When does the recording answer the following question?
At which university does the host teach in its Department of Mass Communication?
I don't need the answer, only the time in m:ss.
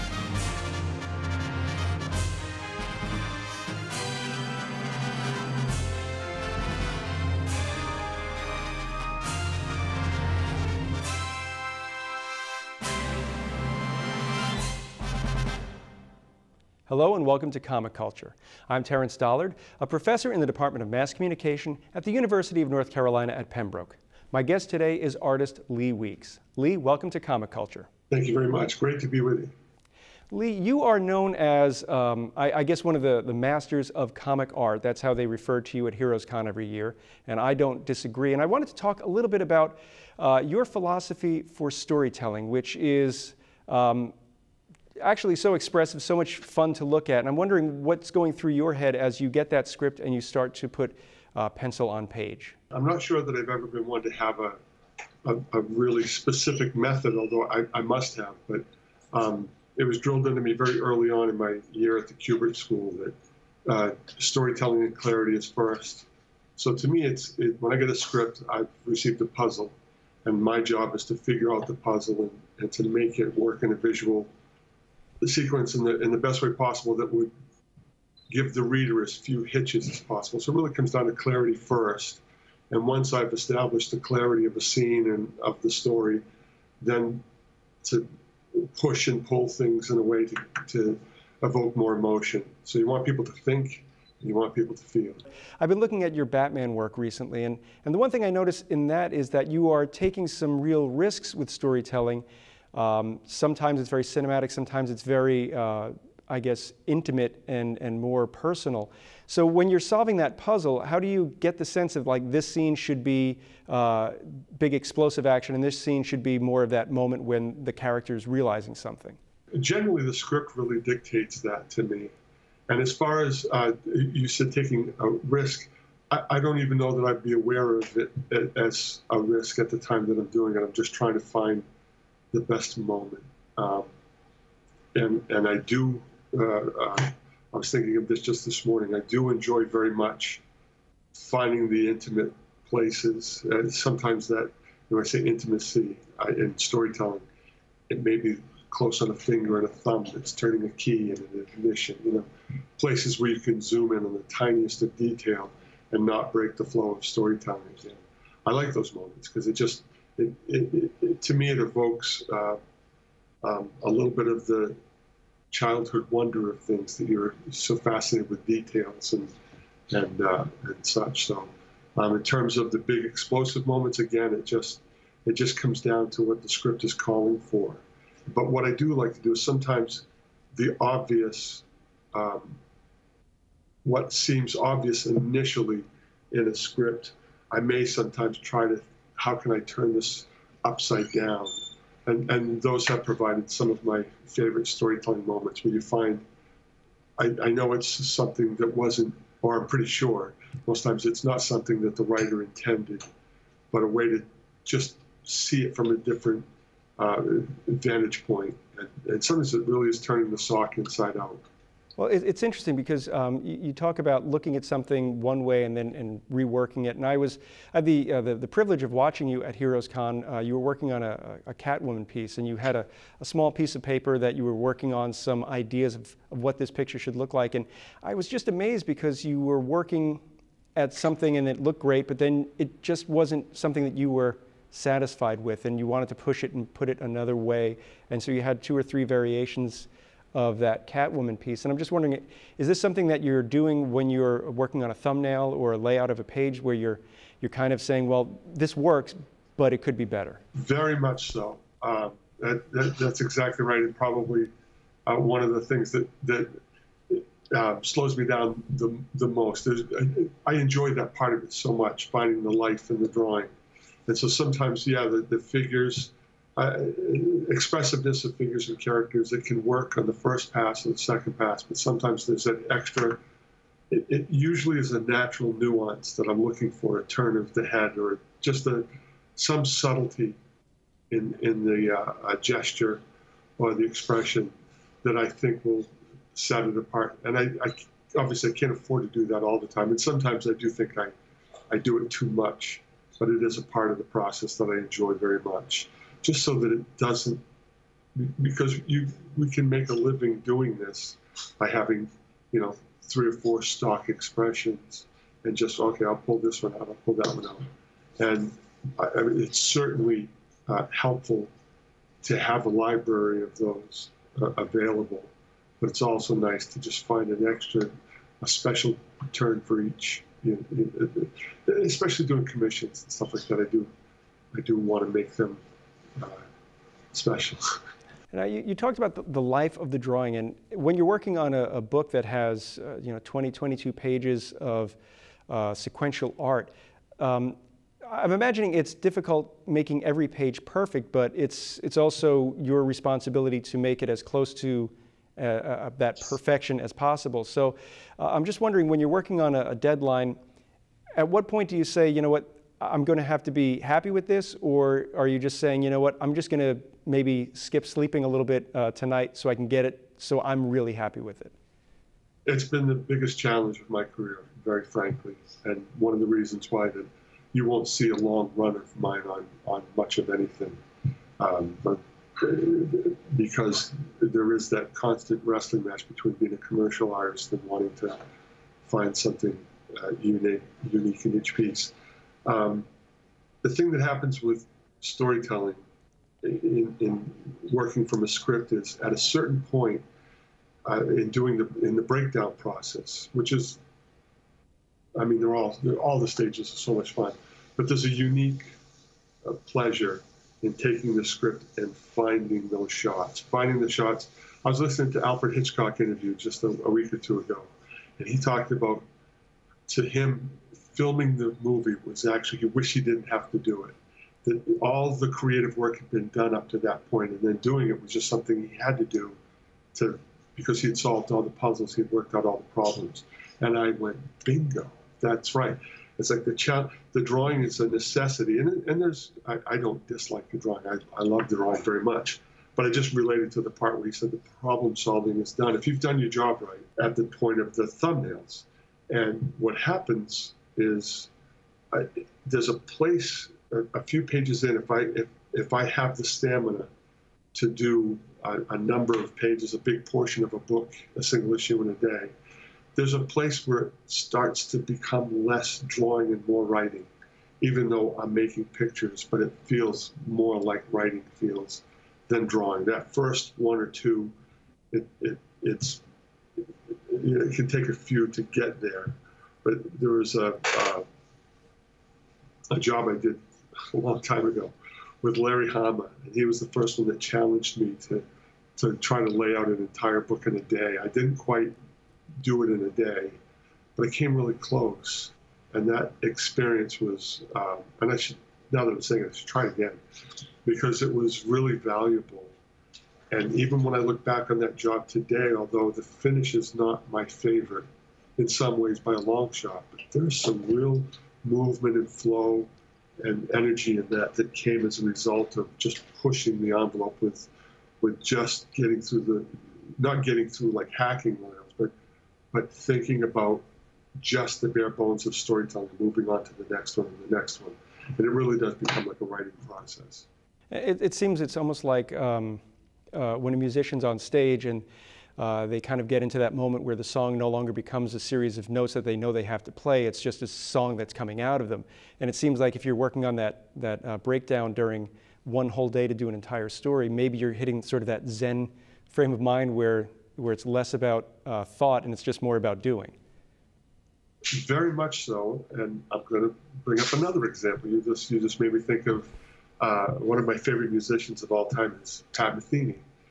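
0:22.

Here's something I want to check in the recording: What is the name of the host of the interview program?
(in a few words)
Terence Dollard.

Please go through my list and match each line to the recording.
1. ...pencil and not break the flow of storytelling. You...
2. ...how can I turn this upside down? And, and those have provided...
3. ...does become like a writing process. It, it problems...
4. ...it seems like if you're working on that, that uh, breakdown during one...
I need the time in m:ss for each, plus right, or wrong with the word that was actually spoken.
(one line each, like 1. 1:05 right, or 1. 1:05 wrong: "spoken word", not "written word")
1. 2:34 wrong: "detail", not "pencil"
2. 3:09 right
3. 8:38 wrong: "seems", not "problems"
4. 8:52 right.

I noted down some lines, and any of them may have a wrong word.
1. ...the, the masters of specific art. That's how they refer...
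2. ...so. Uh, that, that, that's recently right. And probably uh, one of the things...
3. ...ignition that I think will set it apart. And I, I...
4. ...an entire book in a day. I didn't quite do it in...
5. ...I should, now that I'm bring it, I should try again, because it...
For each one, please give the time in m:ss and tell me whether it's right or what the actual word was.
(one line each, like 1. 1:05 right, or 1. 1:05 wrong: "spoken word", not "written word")
1. 0:33 wrong: "comic", not "specific"
2. 4:11 wrong: "exactly", not "recently"
3. 4:43 wrong: "expression", not "ignition"
4. 7:59 right
5. 8:08 wrong: "saying", not "bring".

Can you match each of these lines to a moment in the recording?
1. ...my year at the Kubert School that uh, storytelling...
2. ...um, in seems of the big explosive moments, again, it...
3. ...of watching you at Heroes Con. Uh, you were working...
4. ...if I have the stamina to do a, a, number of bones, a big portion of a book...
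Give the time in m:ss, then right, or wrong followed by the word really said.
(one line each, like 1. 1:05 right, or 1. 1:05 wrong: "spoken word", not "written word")
1. 1:01 right
2. 2:51 wrong: "terms", not "seems"
3. 3:38 right
4. 7:25 wrong: "pages", not "bones".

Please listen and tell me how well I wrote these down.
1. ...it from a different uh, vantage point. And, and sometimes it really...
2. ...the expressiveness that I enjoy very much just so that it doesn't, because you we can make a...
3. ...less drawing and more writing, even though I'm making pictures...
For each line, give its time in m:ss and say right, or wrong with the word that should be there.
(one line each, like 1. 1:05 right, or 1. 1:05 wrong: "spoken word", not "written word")
1. 3:25 right
2. 4:53 wrong: "process", not "expressiveness"
3. 7:35 right.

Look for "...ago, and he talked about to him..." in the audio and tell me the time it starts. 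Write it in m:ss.
6:47.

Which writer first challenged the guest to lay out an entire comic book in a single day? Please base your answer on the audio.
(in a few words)
Larry Hama.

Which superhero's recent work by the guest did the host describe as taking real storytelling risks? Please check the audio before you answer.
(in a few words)
Batman.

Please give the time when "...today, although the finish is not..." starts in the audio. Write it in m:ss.
8:15.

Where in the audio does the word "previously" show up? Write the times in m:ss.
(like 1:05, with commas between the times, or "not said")
not said.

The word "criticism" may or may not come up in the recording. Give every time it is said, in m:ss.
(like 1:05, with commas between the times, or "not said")
not said.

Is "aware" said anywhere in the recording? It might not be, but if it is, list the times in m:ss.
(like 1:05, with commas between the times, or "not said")
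2:07.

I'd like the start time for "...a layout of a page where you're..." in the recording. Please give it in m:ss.
4:05.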